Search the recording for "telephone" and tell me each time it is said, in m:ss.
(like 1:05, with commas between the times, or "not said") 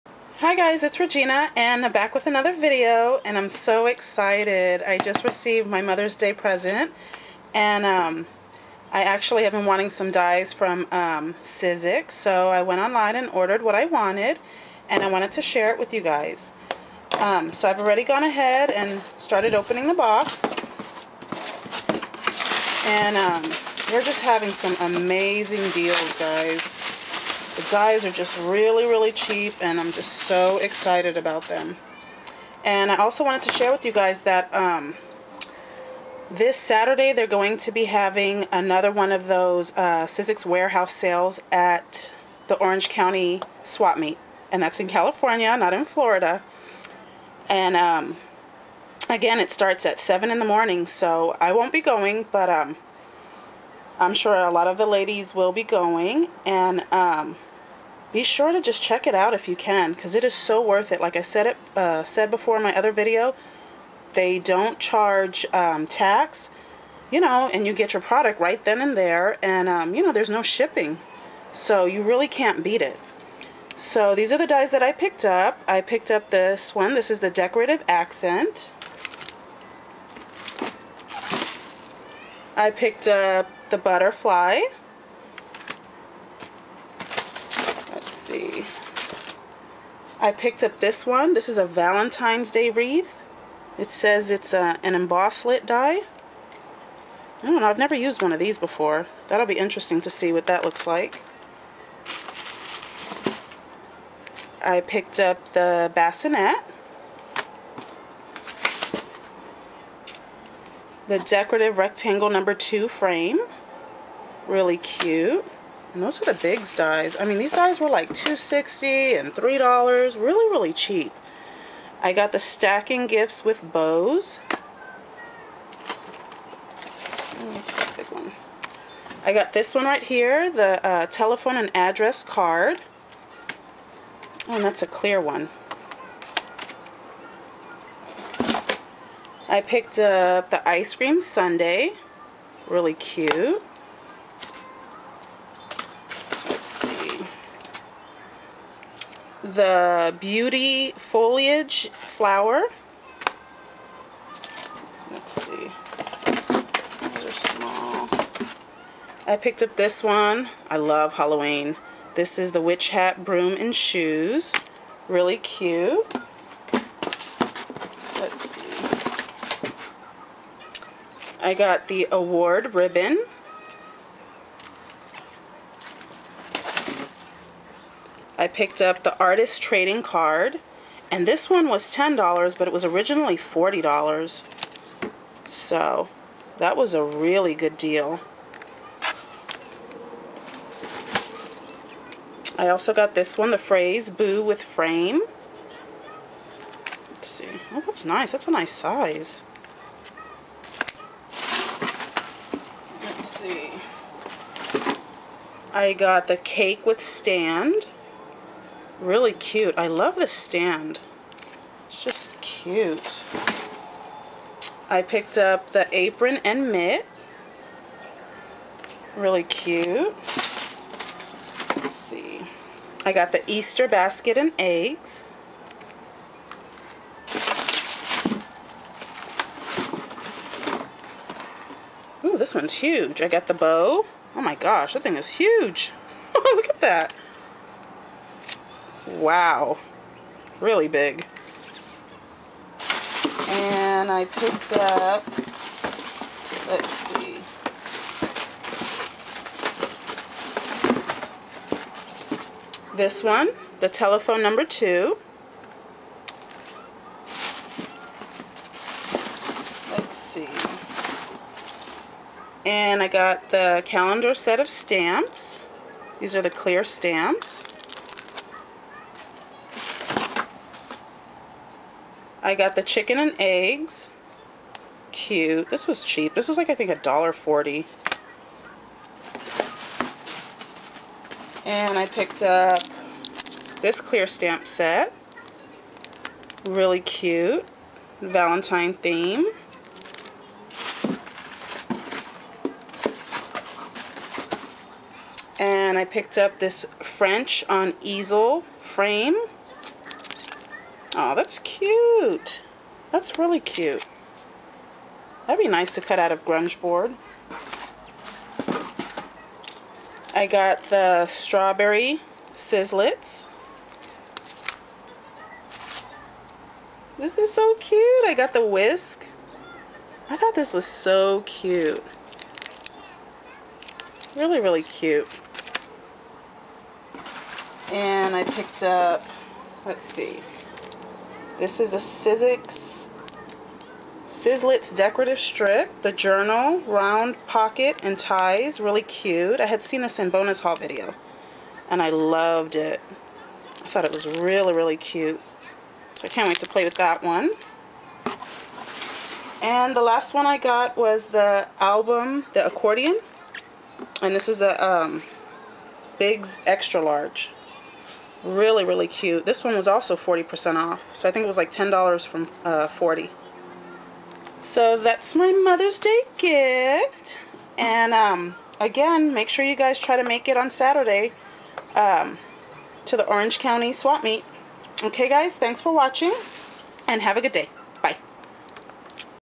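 2:11, 4:13.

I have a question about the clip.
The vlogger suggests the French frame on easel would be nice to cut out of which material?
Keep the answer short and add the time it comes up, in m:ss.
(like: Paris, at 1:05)
Grungeboard, at 5:06.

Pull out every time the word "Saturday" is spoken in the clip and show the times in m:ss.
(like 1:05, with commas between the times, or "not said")
0:36, 6:10.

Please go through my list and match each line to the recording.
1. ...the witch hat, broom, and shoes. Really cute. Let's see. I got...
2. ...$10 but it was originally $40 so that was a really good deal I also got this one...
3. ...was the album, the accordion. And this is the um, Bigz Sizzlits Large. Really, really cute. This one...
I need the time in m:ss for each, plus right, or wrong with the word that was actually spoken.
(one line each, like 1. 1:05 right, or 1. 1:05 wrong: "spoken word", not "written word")
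1. 2:42 right
2. 3:01 right
3. 5:50 wrong: "Extra", not "Sizzlits".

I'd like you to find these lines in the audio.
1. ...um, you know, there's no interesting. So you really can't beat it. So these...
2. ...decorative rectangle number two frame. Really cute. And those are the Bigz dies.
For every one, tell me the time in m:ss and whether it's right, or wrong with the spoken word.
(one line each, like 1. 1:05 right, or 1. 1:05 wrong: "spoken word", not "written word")
1. 1:09 wrong: "shipping", not "interesting"
2. 1:51 right.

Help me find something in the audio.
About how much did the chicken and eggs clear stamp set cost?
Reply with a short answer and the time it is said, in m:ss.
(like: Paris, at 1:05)
$1.40, at 4:36.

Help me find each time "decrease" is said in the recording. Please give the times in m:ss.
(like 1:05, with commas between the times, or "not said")
not said.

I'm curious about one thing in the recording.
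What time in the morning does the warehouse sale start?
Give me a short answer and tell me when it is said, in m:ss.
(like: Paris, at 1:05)
7, at 0:49.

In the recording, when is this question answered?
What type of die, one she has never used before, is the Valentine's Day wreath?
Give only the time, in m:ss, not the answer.
1:34.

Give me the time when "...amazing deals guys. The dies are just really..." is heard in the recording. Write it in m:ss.
0:24.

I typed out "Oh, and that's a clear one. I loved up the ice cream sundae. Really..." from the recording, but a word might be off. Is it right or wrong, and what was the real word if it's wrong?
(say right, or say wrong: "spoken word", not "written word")
wrong: "picked", not "loved".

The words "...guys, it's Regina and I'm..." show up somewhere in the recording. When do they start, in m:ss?
0:00.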